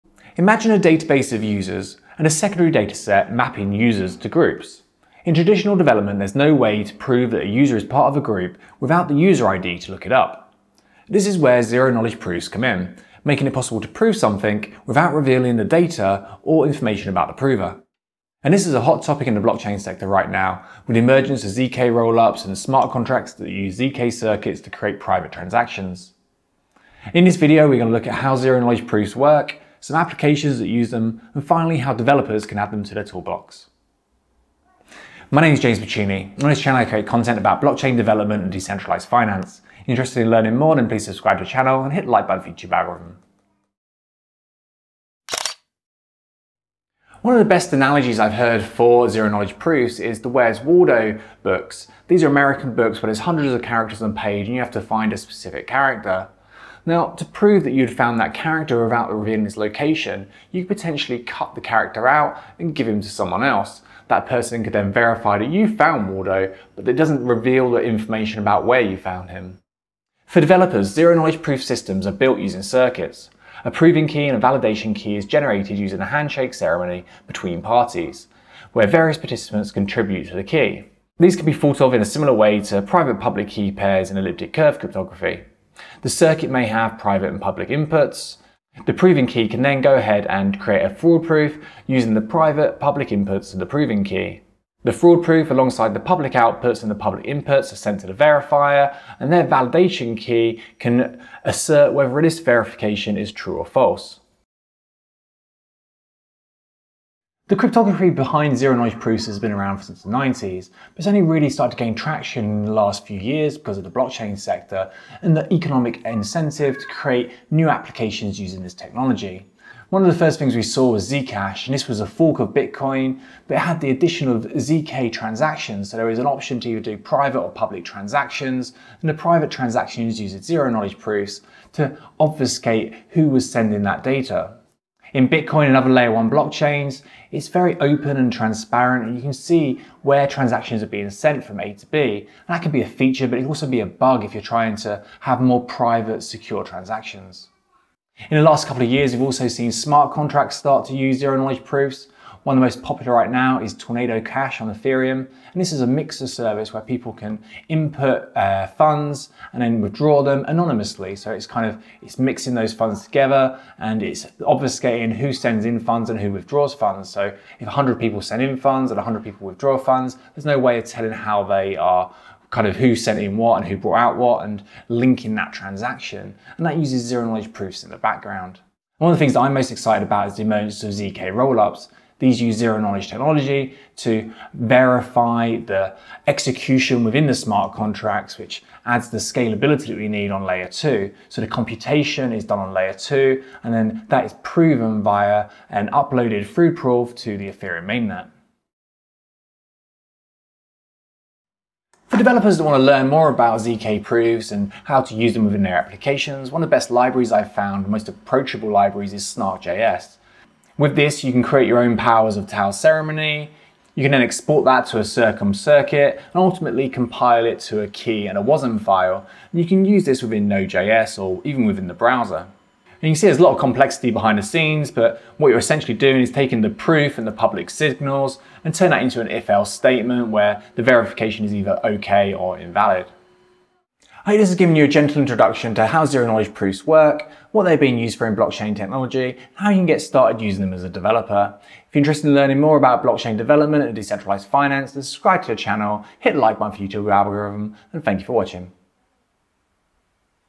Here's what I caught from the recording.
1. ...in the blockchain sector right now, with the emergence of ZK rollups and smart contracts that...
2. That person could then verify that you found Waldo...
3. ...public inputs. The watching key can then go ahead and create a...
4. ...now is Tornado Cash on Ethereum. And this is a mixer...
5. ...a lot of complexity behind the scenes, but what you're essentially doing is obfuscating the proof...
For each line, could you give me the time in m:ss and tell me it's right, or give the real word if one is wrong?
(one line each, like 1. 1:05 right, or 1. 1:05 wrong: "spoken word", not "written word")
1. 0:19 right
2. 1:04 right
3. 1:27 wrong: "proving", not "watching"
4. 2:33 right
5. 3:43 wrong: "taking", not "obfuscating".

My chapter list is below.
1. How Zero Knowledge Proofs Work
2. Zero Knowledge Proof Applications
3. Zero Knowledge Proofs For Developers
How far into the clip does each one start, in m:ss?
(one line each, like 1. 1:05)
1. 0:44
2. 1:44
3. 3:19.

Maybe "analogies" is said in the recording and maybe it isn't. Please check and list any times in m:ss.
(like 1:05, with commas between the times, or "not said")
0:47.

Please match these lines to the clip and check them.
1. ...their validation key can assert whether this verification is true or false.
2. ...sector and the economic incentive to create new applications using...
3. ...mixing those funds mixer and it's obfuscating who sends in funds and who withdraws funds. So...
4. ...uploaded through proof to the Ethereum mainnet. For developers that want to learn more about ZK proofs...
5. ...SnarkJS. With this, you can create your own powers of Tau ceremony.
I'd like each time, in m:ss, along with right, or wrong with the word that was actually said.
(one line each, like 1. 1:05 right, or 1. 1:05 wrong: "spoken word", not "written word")
1. 1:39 right
2. 1:54 right
3. 2:42 wrong: "together", not "mixer"
4. 3:15 right
5. 3:29 right.